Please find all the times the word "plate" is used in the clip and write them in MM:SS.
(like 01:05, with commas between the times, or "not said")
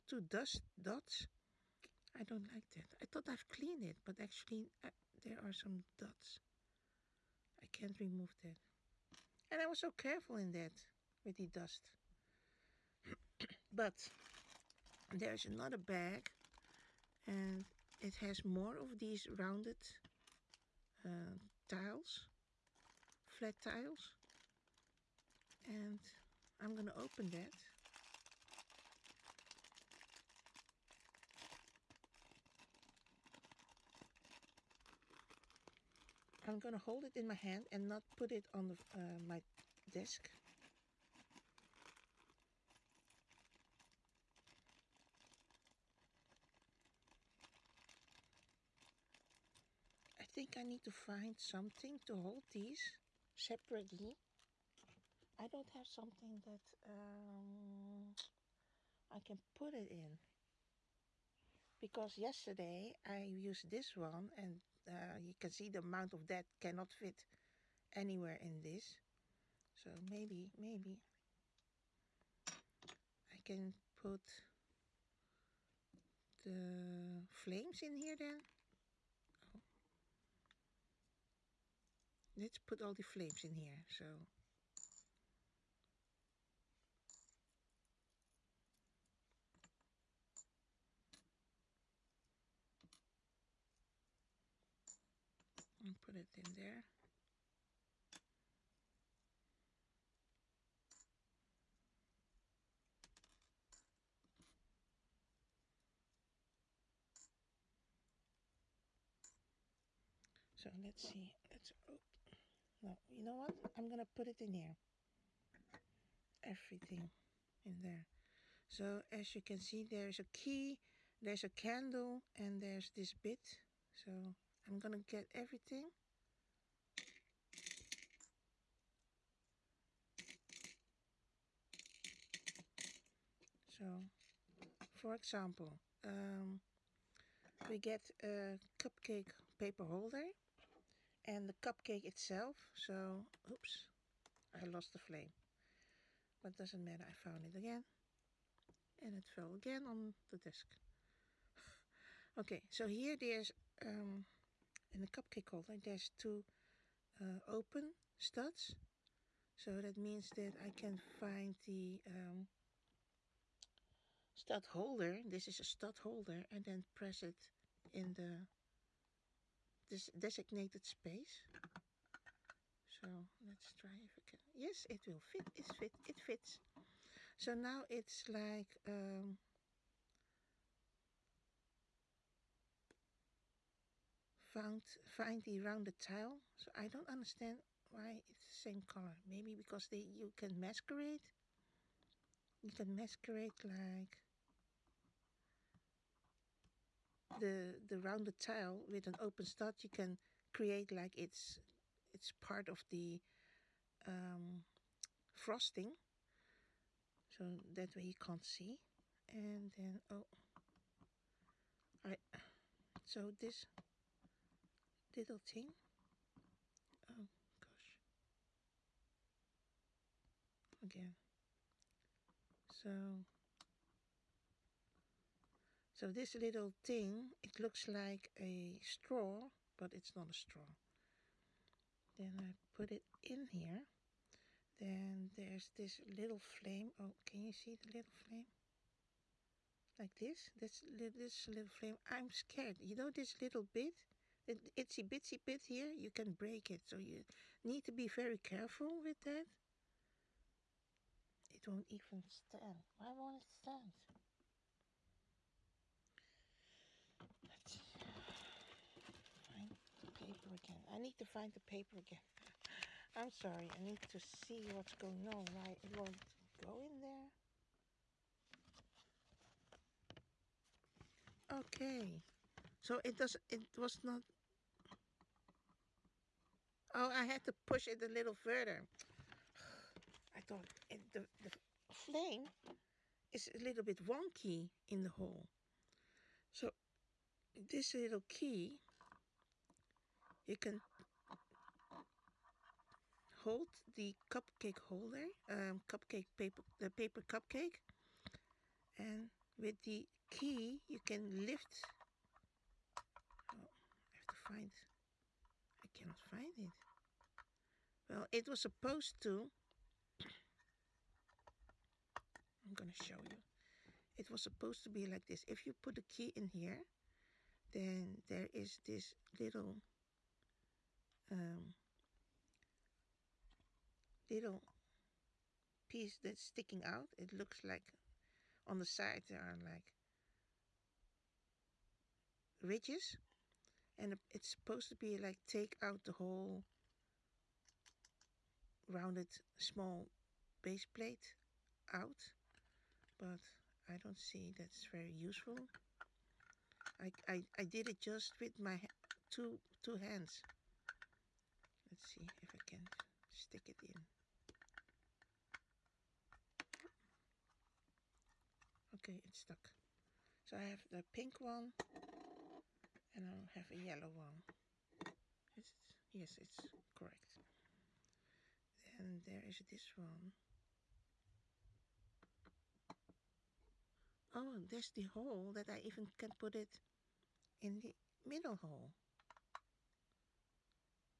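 05:40.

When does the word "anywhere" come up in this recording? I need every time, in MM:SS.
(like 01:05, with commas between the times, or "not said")
01:07.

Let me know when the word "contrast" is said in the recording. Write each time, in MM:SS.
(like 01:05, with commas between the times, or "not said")
not said.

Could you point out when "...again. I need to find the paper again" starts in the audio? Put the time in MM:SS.
04:20.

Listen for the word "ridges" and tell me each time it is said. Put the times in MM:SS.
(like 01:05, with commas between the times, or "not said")
05:32.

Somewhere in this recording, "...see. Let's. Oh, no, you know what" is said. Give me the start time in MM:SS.
01:51.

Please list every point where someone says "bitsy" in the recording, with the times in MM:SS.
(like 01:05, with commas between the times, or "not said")
04:05.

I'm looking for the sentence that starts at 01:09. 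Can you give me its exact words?
So maybe, maybe I can put the flames in here then.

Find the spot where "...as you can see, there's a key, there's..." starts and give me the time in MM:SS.
01:59.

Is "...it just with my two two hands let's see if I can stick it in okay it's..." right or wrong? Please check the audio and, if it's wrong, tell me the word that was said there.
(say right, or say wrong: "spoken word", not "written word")
right.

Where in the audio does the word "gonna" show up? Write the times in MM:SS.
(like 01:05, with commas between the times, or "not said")
01:53, 05:12.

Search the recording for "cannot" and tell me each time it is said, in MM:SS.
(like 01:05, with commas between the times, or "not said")
01:06, 05:05.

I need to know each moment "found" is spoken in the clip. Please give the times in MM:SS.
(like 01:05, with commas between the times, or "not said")
02:27, 03:04.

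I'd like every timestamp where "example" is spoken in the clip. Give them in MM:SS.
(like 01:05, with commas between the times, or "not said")
02:15.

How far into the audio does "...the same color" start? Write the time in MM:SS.
03:08.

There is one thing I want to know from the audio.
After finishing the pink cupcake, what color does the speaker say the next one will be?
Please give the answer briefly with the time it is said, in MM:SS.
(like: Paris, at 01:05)
yellow, at 06:03.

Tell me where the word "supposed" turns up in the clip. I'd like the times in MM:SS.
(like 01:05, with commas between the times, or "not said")
05:08, 05:14, 05:34.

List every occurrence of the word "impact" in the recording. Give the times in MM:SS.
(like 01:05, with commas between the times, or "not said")
not said.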